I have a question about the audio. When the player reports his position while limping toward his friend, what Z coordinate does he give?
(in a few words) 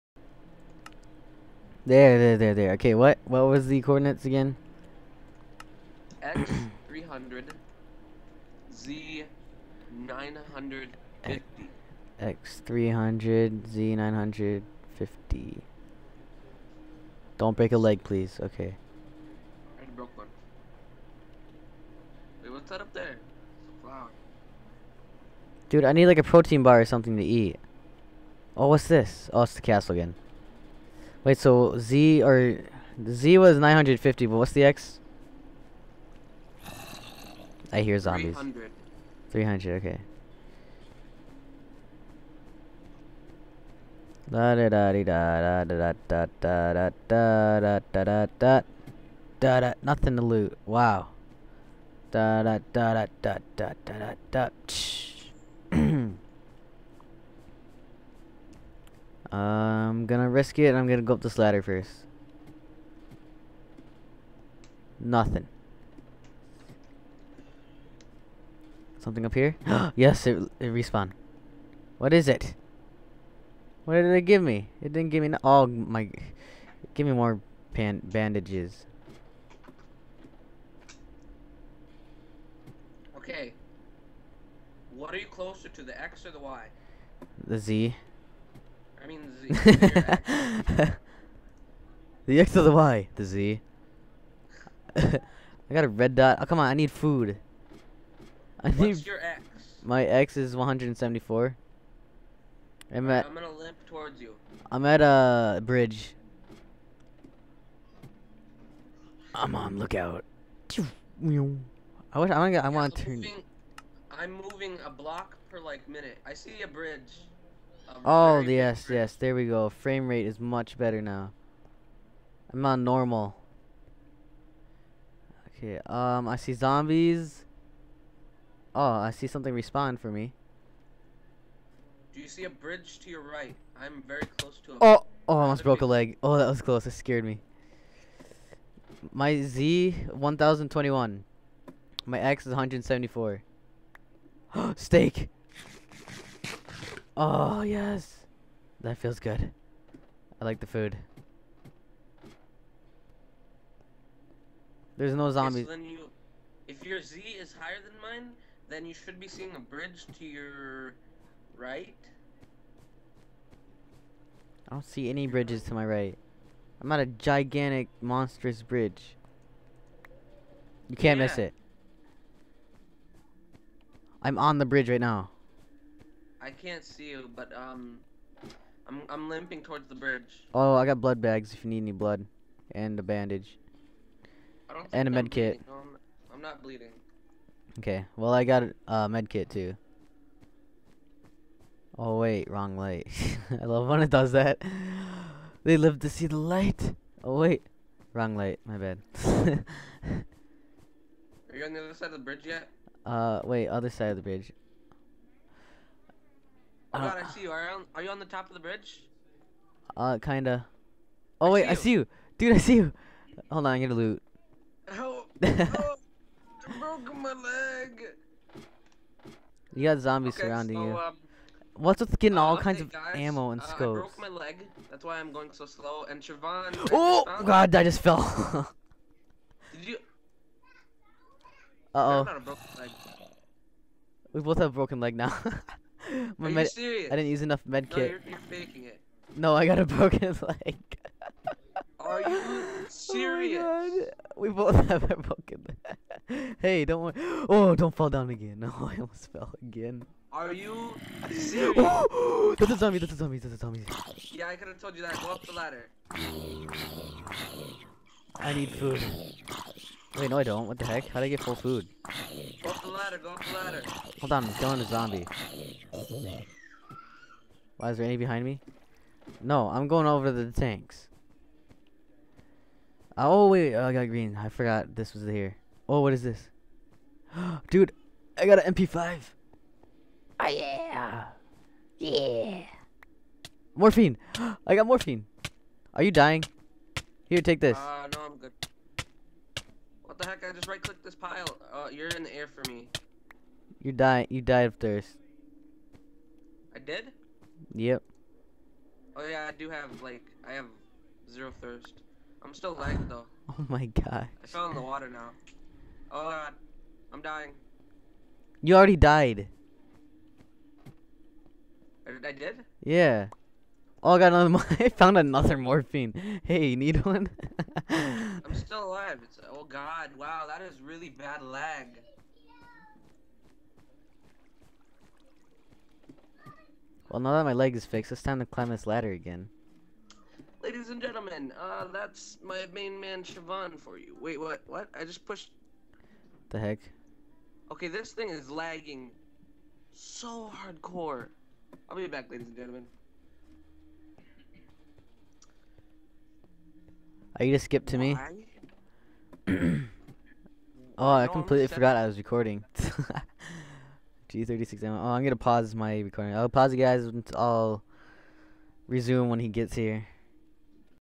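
1021.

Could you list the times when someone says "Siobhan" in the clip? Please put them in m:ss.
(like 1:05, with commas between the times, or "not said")
3:46, 5:33.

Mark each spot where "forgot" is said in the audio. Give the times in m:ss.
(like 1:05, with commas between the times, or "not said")
4:34, 5:51.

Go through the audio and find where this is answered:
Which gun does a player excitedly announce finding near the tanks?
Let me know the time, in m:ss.
4:38.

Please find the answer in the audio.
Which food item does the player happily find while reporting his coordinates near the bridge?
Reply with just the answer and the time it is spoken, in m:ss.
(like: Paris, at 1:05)
Steak, at 2:24.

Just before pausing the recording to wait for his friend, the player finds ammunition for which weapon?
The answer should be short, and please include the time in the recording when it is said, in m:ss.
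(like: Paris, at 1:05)
G36, at 5:54.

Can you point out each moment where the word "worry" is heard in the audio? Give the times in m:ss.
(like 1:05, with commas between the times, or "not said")
4:07.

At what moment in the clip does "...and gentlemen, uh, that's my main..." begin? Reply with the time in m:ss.
5:30.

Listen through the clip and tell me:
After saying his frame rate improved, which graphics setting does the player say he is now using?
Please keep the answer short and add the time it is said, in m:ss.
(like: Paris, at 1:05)
normal, at 2:02.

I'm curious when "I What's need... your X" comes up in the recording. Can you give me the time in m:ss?
1:38.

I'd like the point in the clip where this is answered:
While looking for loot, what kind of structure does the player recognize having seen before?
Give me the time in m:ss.
0:29.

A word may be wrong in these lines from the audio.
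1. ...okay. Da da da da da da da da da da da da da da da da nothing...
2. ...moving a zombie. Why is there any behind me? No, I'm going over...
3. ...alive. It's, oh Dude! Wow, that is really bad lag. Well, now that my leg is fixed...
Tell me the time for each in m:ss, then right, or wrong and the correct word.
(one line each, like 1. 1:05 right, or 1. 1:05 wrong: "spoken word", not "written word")
1. 0:39 right
2. 4:24 wrong: "killing", not "moving"
3. 5:18 wrong: "God", not "Dude".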